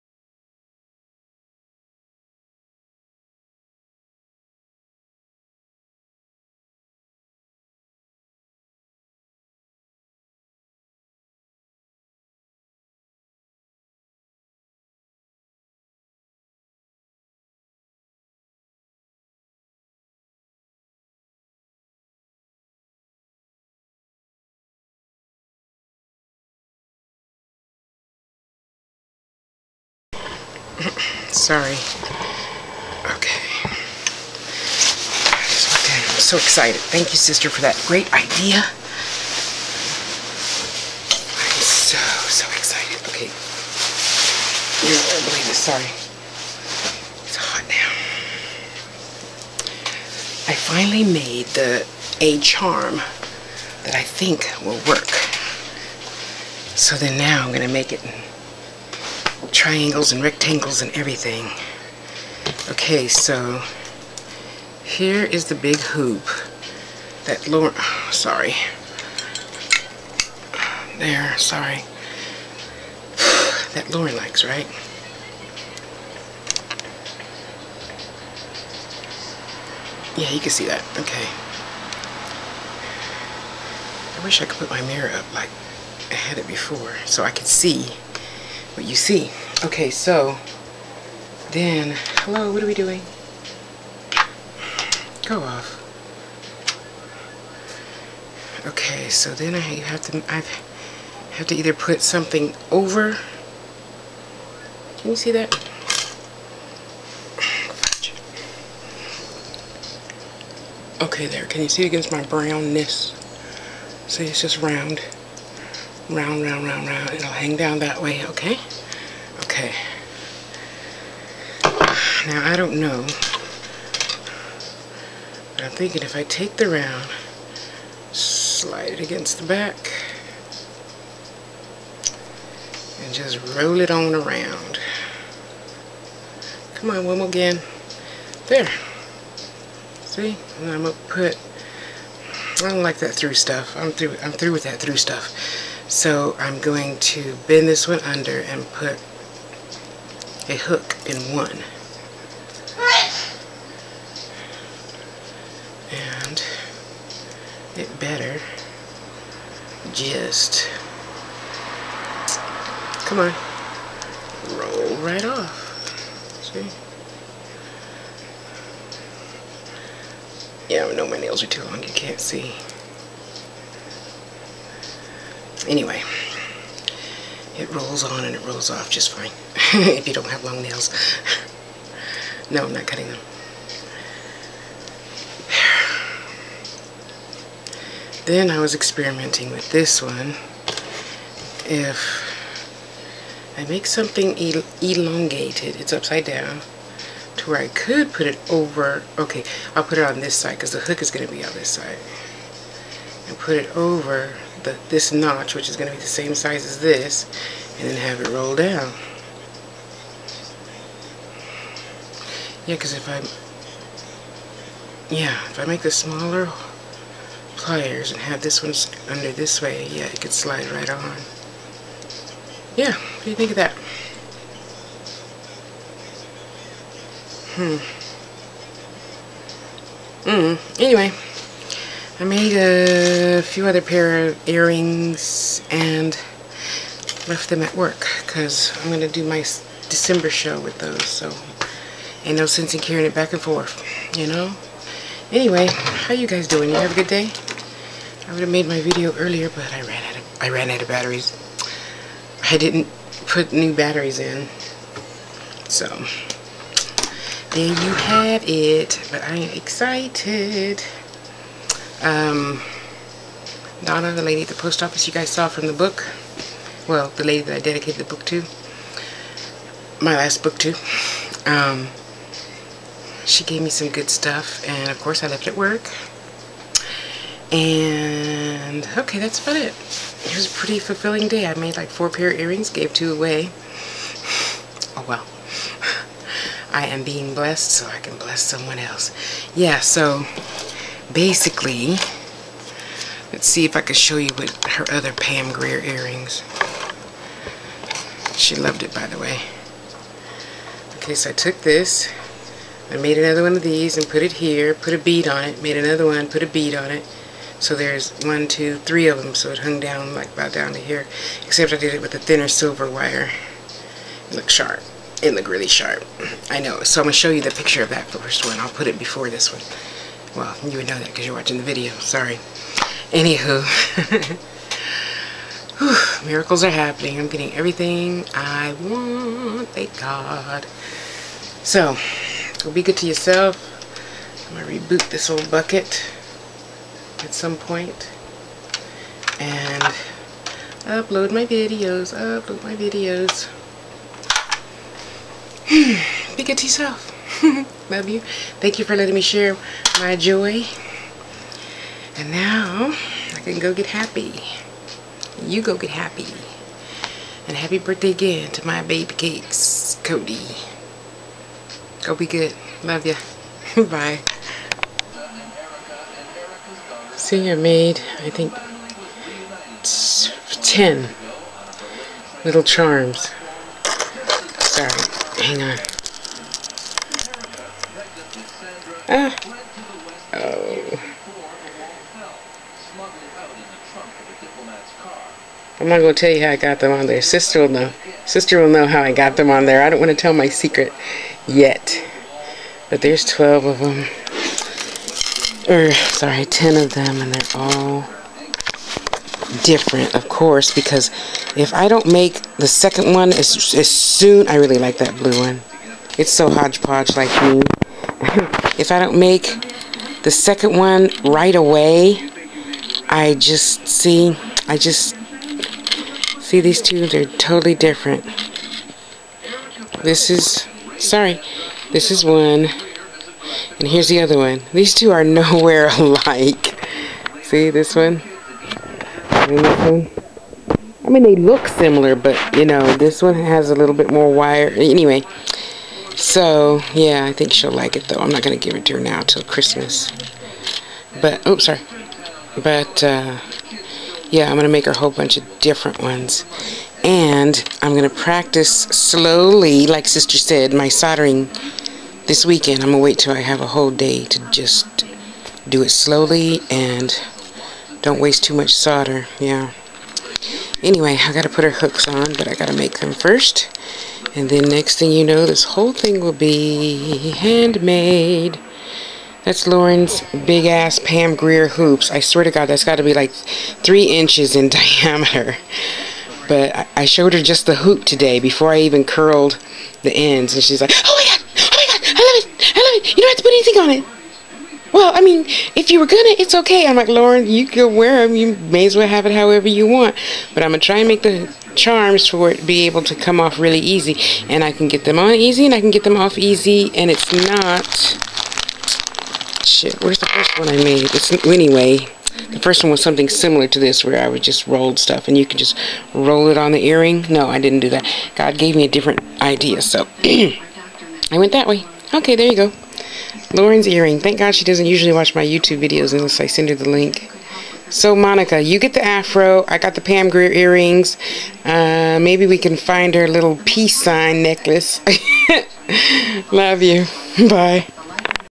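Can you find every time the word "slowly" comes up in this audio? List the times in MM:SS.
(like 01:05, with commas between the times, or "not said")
07:28, 07:35.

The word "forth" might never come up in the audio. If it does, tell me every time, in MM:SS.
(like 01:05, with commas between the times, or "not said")
04:03.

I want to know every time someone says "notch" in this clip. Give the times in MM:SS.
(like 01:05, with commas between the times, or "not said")
03:25.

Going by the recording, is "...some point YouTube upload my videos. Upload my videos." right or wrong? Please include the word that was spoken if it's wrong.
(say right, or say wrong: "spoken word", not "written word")
wrong: "And", not "YouTube".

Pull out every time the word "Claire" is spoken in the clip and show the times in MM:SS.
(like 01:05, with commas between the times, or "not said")
not said.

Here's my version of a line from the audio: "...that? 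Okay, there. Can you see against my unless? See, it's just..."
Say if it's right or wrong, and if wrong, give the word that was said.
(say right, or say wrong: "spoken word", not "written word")
wrong: "brownness", not "unless".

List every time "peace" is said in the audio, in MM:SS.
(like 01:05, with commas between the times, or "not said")
08:43.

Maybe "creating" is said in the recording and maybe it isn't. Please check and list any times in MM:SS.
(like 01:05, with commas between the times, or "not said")
not said.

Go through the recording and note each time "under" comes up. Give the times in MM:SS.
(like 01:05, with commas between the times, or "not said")
02:27, 03:39.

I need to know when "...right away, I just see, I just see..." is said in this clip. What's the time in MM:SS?
06:51.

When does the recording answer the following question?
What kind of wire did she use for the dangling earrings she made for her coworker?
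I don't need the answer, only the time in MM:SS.
05:12.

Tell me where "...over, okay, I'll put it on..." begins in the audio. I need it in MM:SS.
03:18.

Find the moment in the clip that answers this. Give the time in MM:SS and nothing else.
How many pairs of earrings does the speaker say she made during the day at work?
04:41.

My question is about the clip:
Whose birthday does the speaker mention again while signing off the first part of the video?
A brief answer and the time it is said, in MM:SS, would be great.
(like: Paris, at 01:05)
Cody, at 06:00.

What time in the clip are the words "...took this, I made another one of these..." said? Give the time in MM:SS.
05:01.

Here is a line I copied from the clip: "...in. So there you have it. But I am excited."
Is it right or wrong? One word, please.
right.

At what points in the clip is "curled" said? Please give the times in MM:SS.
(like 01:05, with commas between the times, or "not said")
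07:59.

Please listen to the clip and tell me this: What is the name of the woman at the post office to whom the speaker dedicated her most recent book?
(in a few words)
Donna.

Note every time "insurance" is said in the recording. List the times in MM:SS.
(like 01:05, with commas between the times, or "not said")
not said.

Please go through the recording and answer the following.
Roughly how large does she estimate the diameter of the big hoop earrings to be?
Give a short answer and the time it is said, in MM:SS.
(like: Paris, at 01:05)
3 inches, at 07:53.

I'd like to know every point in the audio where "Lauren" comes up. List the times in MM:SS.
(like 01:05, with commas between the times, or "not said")
01:07, 01:13, 07:49, 08:07, 08:33.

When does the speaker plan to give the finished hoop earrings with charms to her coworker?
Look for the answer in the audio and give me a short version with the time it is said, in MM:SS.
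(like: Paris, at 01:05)
Christmas, at 07:19.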